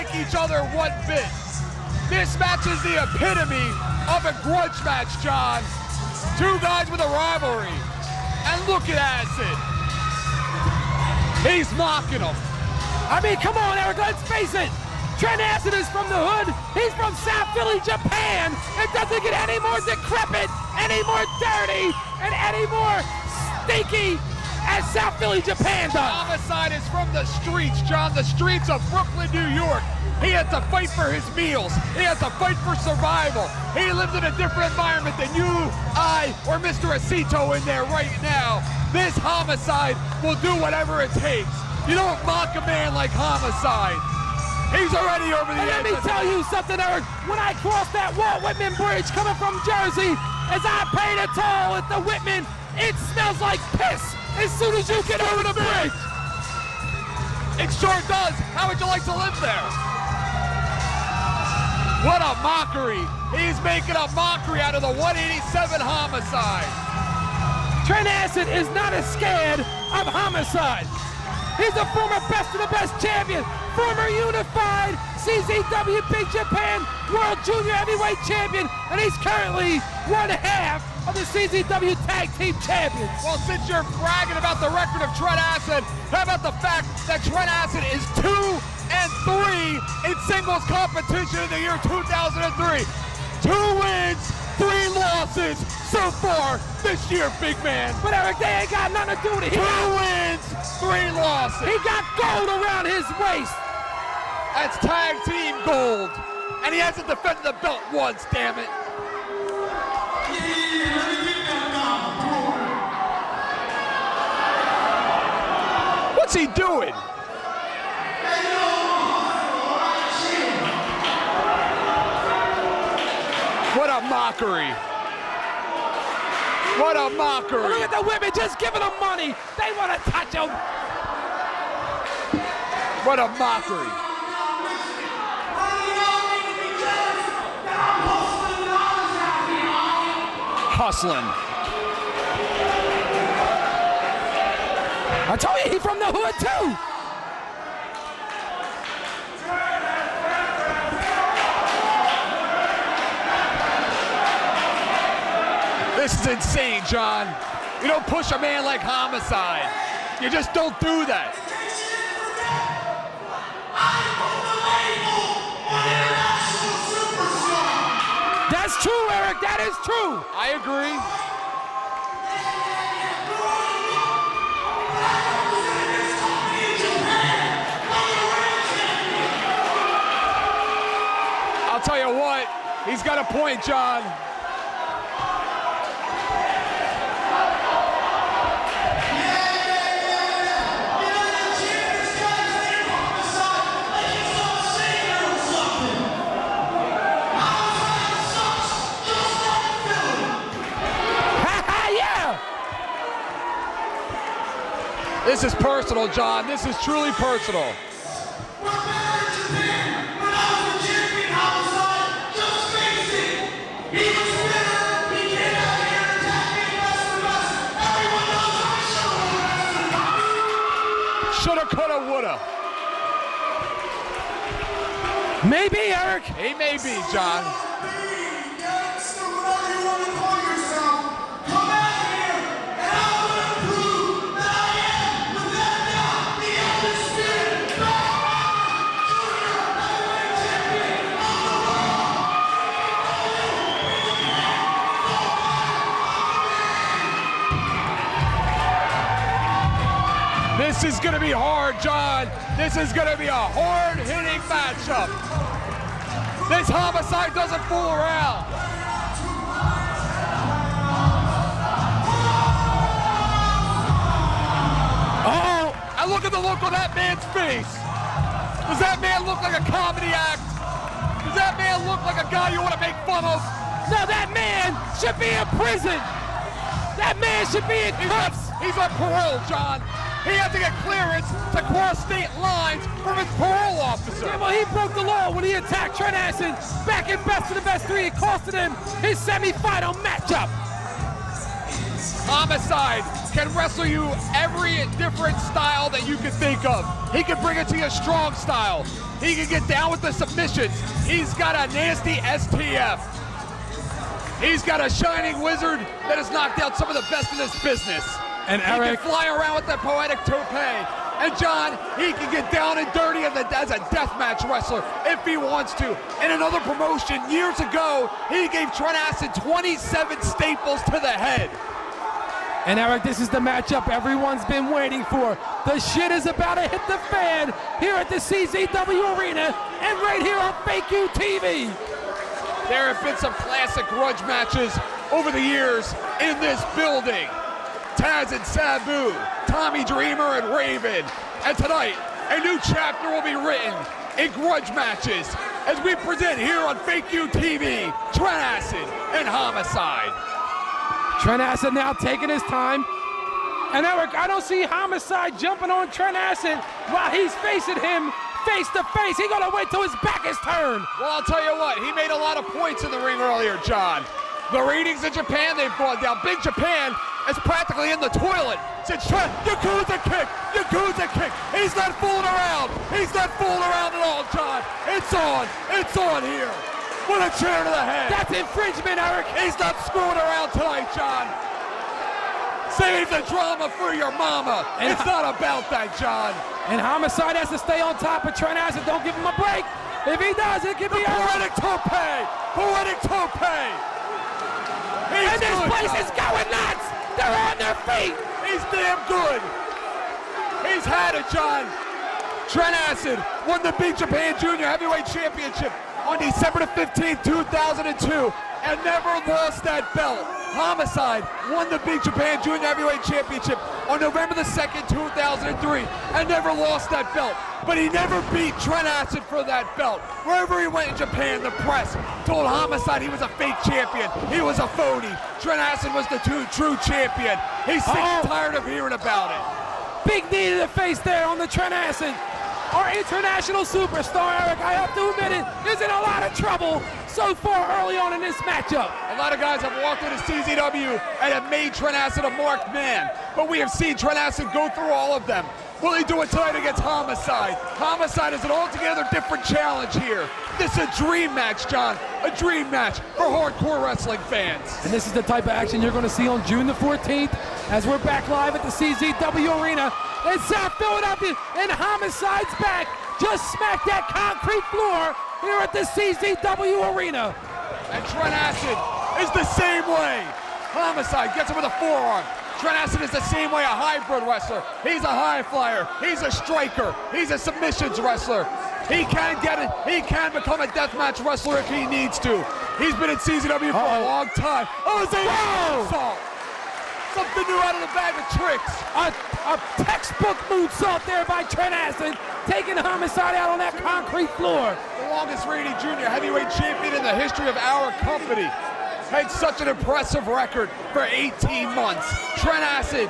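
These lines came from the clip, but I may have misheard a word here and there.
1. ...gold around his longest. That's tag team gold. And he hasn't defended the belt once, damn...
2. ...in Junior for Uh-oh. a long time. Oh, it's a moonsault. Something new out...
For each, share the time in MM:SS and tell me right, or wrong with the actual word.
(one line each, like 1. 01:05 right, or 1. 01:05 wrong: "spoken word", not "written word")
1. 01:42 wrong: "waist", not "longest"
2. 08:03 wrong: "CZW", not "Junior".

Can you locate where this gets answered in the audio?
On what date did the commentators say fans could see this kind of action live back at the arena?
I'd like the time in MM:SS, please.
07:36.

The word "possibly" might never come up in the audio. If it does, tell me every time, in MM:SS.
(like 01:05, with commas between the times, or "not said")
not said.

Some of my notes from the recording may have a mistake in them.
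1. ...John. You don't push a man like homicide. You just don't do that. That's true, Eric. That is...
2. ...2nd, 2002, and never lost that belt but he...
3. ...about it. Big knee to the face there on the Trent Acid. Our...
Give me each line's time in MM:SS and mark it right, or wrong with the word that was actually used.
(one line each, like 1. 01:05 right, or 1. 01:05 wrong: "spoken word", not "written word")
1. 02:36 right
2. 06:54 wrong: "2003", not "2002"
3. 07:08 right.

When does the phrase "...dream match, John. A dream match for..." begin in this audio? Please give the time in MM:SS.
07:30.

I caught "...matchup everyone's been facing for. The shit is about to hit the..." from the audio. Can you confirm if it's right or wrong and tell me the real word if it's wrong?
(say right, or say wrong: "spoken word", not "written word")
wrong: "waiting", not "facing".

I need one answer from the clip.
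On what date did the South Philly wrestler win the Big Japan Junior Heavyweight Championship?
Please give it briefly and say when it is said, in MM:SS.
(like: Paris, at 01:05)
December 15, 2002, at 06:46.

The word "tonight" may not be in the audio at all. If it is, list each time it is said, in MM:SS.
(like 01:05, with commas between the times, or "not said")
05:41, 06:20, 07:26.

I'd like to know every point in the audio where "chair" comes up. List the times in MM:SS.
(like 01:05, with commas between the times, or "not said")
06:17.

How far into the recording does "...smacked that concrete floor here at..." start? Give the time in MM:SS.
07:43.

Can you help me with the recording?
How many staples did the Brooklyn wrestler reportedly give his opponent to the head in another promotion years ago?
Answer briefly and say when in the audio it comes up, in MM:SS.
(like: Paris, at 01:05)
27, at 05:19.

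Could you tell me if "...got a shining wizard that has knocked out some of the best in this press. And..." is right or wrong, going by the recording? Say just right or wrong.
wrong.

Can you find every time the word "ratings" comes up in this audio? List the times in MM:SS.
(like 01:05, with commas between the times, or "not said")
06:04.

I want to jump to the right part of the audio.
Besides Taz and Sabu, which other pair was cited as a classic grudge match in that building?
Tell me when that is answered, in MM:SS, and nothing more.
05:39.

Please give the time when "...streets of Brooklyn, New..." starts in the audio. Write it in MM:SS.
00:28.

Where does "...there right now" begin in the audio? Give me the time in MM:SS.
00:37.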